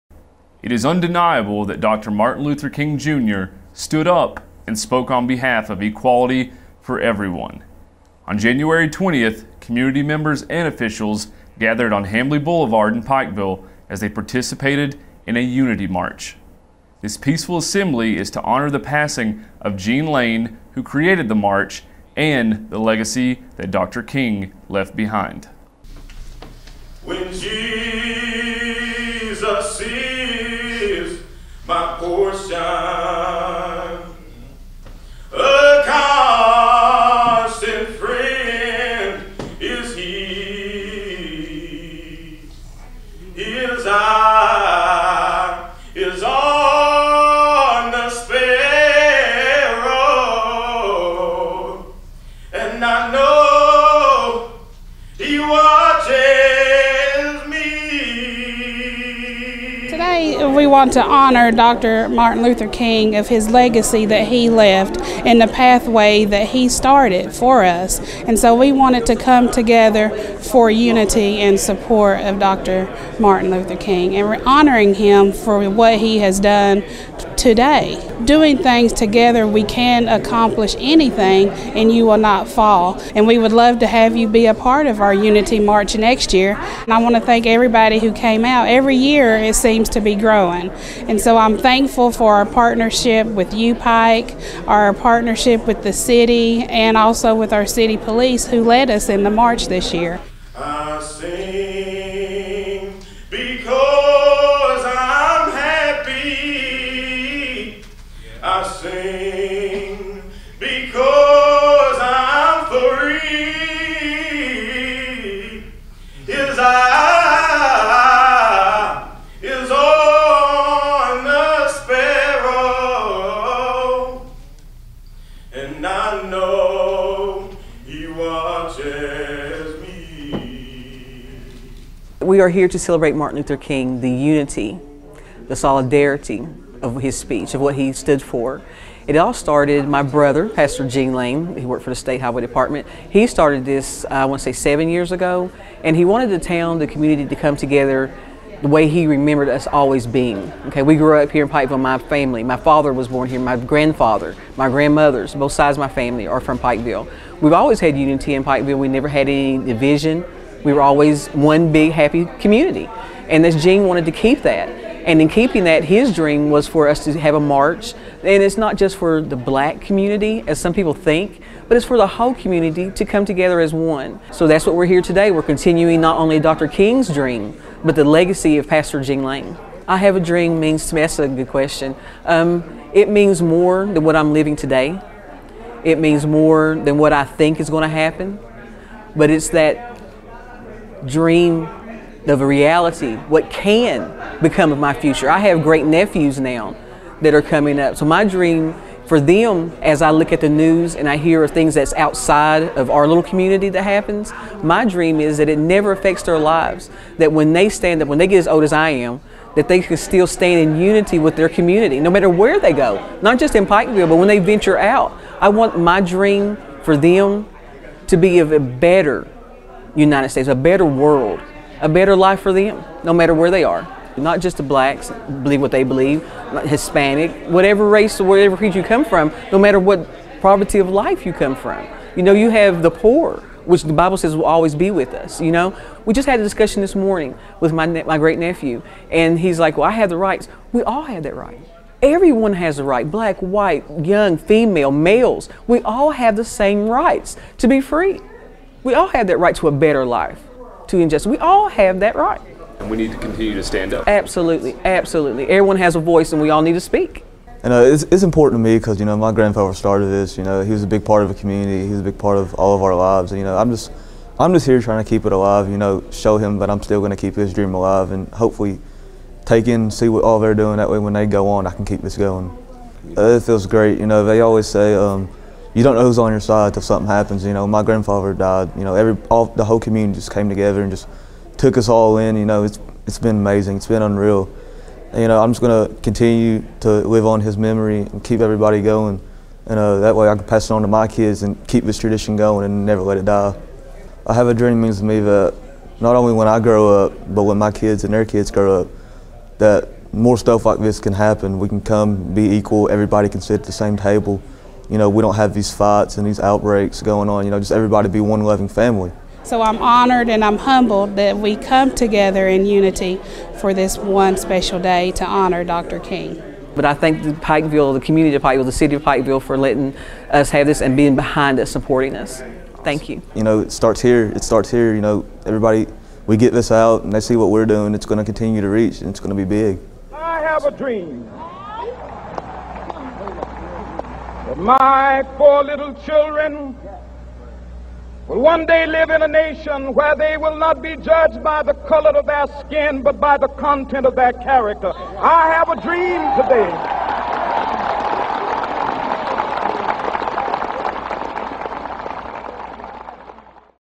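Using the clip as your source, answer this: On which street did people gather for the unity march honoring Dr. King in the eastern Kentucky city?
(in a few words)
Hambley Boulevard.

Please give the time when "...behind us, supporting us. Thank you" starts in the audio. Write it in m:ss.
5:21.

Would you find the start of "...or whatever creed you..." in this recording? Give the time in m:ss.
3:48.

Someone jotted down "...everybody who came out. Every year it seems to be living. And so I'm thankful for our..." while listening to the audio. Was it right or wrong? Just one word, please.
wrong.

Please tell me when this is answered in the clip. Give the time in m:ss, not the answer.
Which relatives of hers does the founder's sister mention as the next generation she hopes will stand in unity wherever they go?
3:15.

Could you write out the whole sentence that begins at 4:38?
You know, every all the whole community just came together and just took us all in.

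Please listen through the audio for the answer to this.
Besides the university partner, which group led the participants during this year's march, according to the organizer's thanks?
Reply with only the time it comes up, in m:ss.
1:37.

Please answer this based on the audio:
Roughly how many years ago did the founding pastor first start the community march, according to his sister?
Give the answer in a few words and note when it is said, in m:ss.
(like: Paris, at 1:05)
7, at 2:24.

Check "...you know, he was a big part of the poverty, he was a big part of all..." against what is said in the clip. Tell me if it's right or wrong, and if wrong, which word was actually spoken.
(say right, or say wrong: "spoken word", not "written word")
wrong: "community", not "poverty".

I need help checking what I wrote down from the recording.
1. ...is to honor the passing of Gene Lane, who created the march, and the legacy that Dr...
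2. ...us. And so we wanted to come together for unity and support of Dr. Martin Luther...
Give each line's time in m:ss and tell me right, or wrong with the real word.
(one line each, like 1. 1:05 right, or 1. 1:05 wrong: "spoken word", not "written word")
1. 0:18 right
2. 1:07 right.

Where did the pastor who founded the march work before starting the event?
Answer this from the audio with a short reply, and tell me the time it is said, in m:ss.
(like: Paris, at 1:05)
State Highway Department, at 2:21.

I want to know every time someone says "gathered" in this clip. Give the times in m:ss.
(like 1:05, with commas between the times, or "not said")
0:11.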